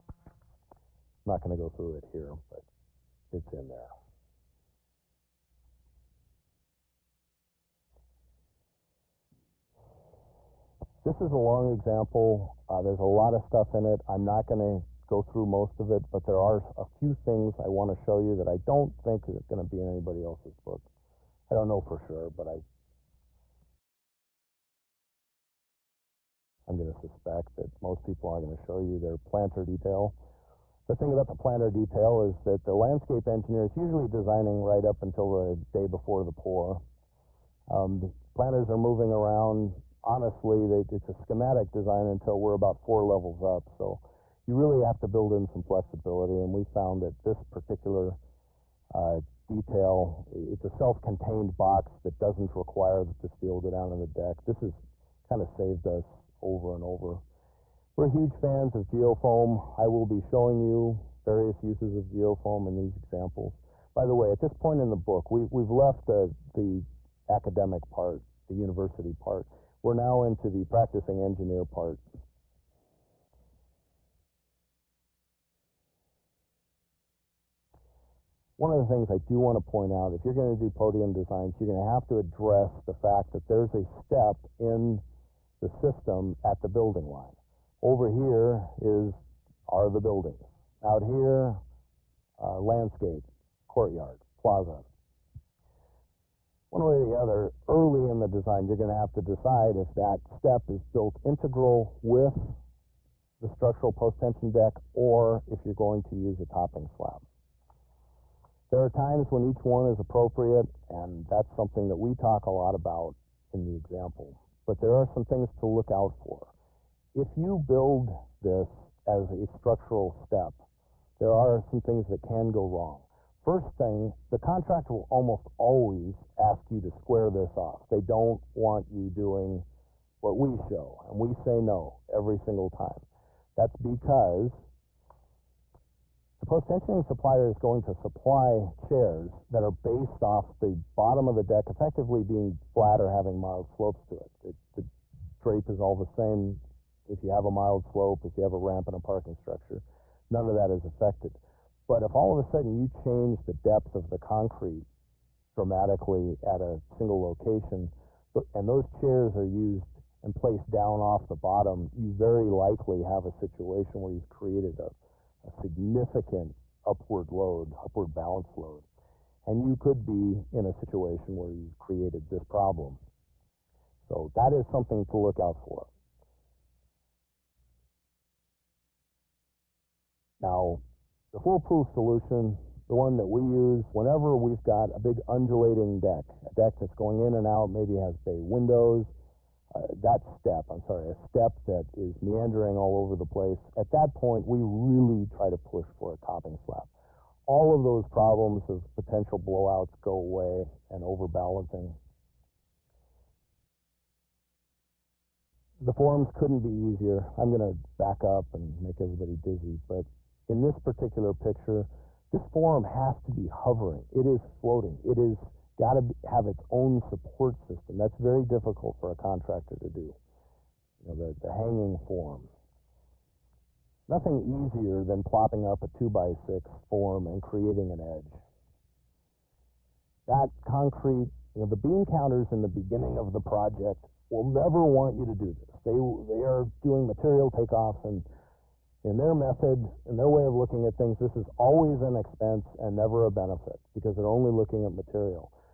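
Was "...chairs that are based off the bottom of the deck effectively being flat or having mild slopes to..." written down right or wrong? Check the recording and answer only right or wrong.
right.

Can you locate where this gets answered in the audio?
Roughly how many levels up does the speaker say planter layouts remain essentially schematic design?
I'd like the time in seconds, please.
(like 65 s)
42 s.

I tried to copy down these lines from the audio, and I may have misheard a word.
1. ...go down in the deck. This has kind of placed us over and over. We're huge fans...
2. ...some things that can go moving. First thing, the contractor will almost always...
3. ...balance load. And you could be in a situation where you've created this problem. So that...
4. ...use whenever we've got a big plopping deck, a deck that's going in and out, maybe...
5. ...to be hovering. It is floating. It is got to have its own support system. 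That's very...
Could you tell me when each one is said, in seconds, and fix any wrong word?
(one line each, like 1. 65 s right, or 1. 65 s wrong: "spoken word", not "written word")
1. 53 s wrong: "saved", not "placed"
2. 121 s wrong: "wrong", not "moving"
3. 168 s right
4. 183 s wrong: "undulating", not "plopping"
5. 213 s right.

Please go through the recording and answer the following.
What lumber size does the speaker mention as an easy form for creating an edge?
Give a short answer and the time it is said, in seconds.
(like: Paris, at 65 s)
2 by 6, at 225 s.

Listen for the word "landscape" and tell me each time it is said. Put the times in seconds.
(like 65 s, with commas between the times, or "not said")
32 s, 92 s.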